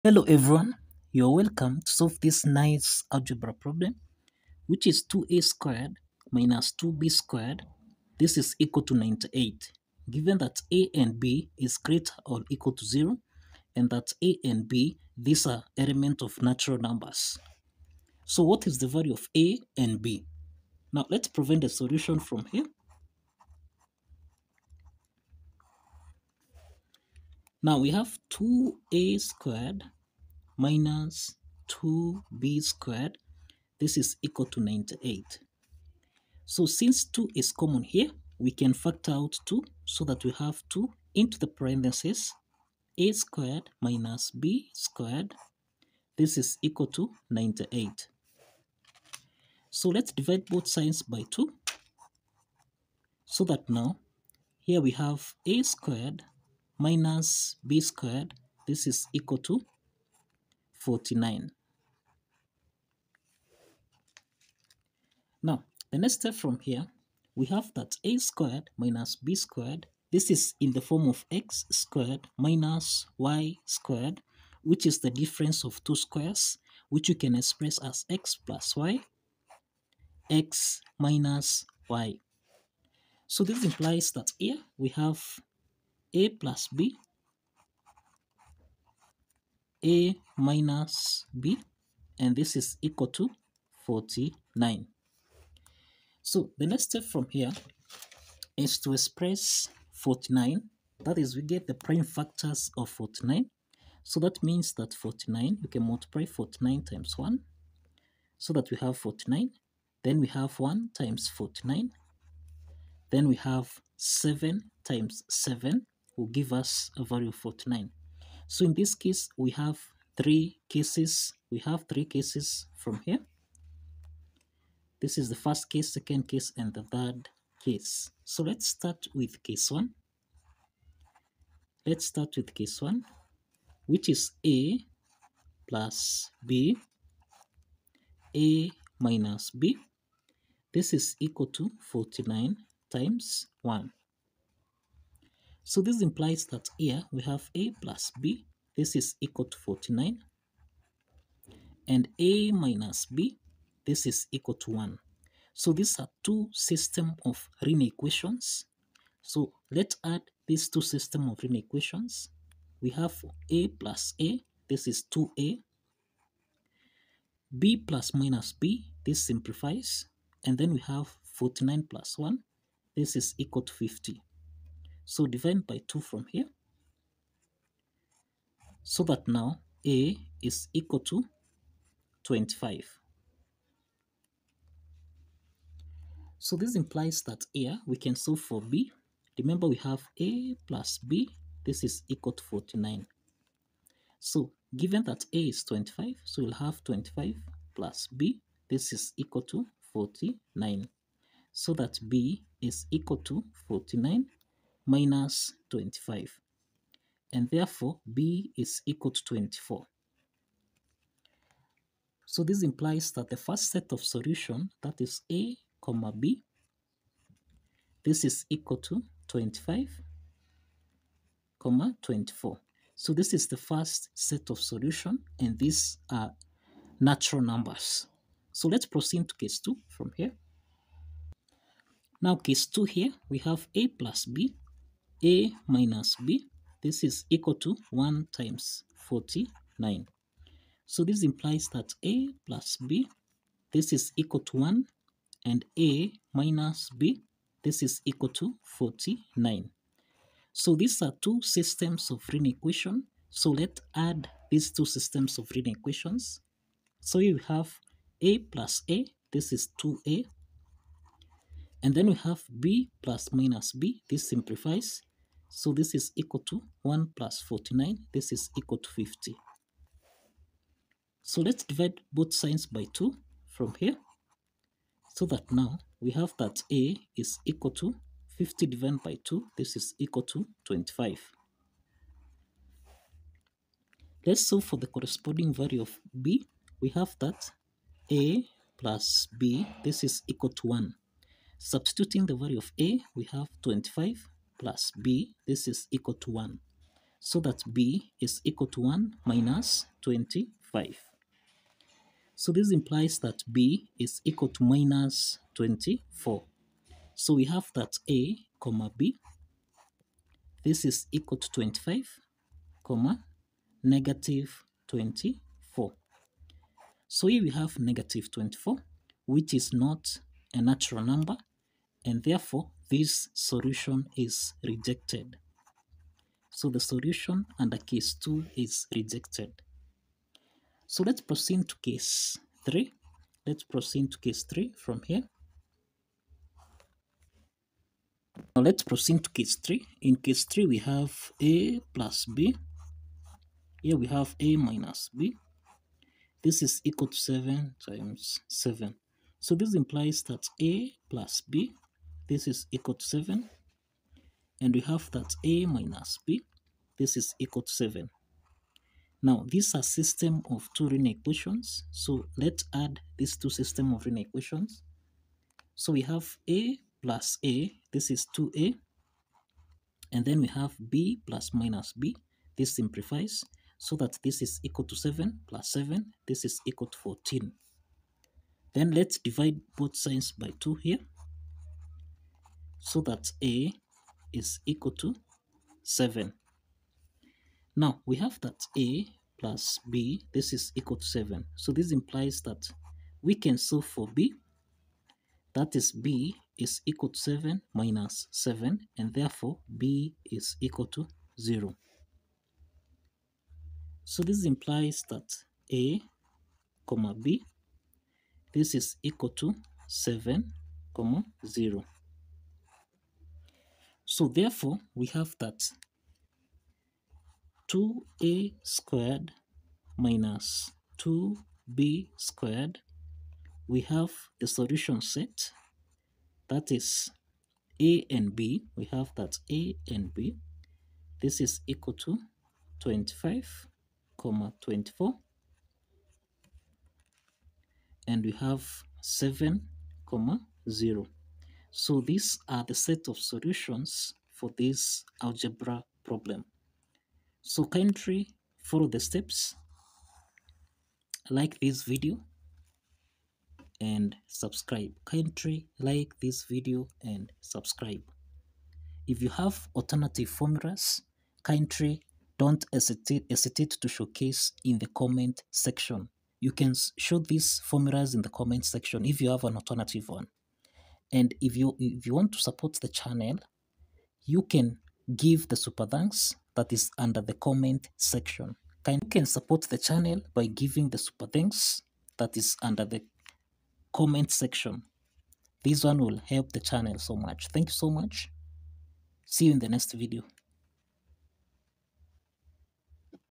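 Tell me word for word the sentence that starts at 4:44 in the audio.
Let's solve for the corresponding value of B.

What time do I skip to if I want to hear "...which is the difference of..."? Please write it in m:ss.
1:14.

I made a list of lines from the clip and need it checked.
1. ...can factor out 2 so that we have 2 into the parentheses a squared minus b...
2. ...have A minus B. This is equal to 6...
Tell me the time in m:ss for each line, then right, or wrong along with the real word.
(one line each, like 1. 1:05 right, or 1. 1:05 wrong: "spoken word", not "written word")
1. 0:38 right
2. 5:44 wrong: "7", not "6".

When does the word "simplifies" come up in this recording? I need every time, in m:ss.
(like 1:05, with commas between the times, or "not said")
2:49, 4:24, 6:12.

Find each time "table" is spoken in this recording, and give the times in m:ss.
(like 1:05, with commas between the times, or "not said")
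not said.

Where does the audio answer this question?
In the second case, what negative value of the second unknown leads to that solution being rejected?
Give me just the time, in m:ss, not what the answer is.
5:04.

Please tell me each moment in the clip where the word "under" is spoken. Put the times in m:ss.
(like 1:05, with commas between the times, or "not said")
5:27, 7:56, 8:02.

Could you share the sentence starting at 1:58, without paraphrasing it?
So in this case, we have three cases.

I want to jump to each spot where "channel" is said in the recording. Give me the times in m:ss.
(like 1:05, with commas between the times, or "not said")
7:52, 7:59, 8:06.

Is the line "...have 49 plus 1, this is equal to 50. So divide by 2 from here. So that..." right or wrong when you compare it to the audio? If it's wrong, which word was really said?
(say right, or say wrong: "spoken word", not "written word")
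right.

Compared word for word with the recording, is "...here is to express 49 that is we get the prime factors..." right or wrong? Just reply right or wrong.
right.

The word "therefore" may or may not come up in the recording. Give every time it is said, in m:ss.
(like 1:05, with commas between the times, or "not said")
3:27, 5:22, 6:39, 6:54.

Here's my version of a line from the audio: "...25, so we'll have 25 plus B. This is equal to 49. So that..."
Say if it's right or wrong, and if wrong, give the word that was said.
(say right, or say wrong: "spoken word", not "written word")
right.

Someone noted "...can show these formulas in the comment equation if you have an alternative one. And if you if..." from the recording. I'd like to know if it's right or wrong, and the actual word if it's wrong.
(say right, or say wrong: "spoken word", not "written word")
wrong: "section", not "equation".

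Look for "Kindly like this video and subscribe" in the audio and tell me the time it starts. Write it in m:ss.
7:35.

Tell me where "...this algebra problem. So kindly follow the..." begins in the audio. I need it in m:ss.
7:24.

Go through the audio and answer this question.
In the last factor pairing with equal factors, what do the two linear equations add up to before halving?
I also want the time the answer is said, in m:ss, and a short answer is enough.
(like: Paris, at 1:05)
14, at 6:16.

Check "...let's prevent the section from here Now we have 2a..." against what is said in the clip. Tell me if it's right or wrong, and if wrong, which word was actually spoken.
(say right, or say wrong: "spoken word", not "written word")
wrong: "solution", not "section".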